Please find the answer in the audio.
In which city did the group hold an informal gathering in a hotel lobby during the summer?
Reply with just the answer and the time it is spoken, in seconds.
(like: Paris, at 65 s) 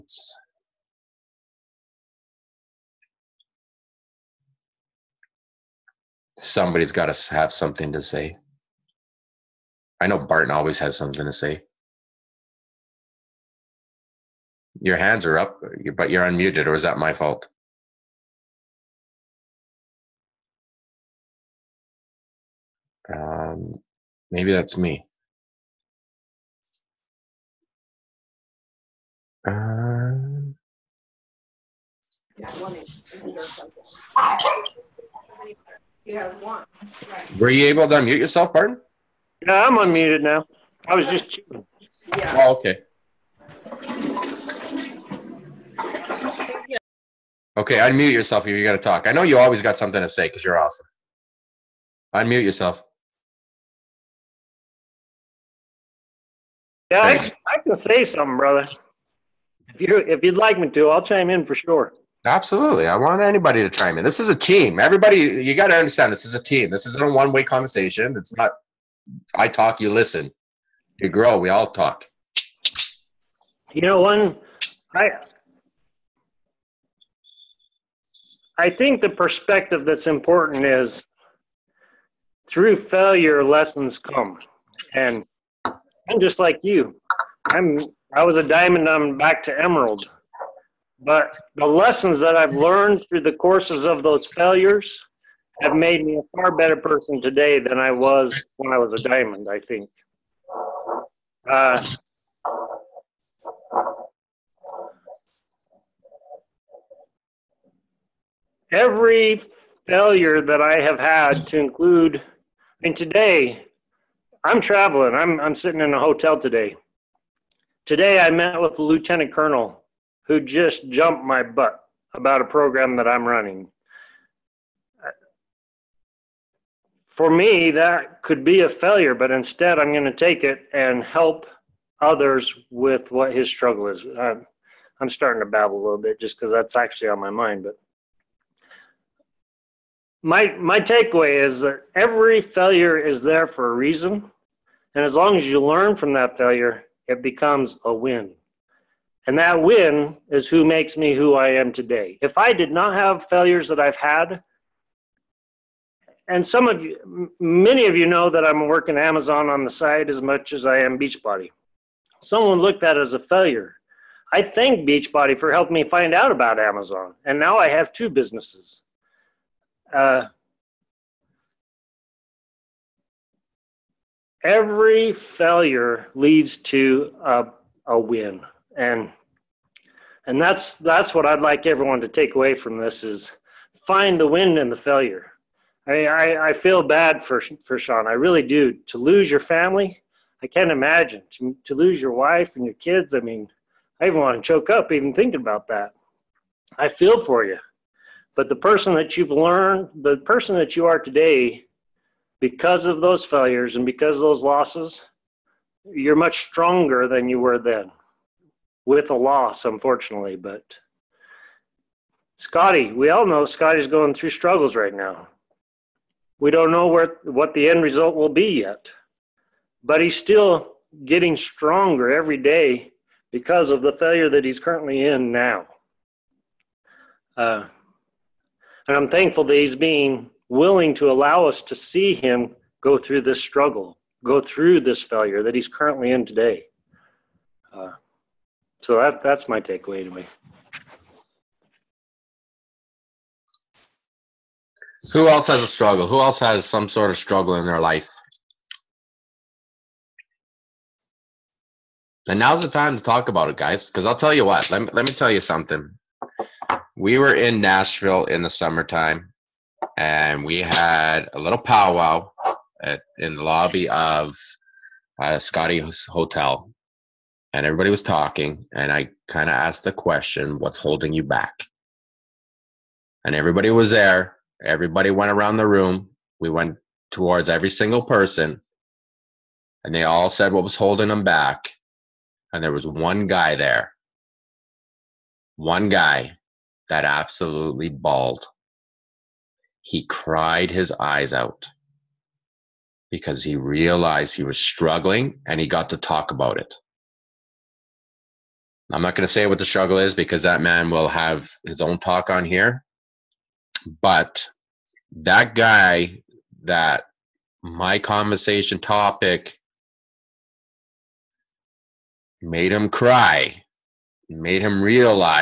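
Nashville, at 257 s.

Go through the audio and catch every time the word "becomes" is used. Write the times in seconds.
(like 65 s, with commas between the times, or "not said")
147 s.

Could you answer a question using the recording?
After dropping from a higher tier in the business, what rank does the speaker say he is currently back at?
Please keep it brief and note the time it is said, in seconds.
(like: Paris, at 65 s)
emerald, at 89 s.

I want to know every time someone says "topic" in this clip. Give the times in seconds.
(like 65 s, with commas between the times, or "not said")
308 s.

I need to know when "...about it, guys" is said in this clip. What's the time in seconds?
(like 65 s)
253 s.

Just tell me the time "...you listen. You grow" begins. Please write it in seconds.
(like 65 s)
69 s.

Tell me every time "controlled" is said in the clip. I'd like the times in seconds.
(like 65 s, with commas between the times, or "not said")
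not said.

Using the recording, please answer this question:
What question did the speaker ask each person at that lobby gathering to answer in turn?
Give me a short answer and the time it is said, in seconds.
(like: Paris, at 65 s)
What's holding you back?, at 270 s.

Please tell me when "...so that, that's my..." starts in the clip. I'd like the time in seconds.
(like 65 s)
238 s.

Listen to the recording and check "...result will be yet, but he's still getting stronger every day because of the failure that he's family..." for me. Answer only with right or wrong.
wrong.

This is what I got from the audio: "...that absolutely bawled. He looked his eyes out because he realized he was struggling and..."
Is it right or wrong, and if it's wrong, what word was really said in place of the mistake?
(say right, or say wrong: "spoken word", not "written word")
wrong: "cried", not "looked".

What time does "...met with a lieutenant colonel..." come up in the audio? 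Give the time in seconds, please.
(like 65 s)
118 s.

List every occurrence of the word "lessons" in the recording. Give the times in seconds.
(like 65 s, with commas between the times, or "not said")
83 s, 91 s.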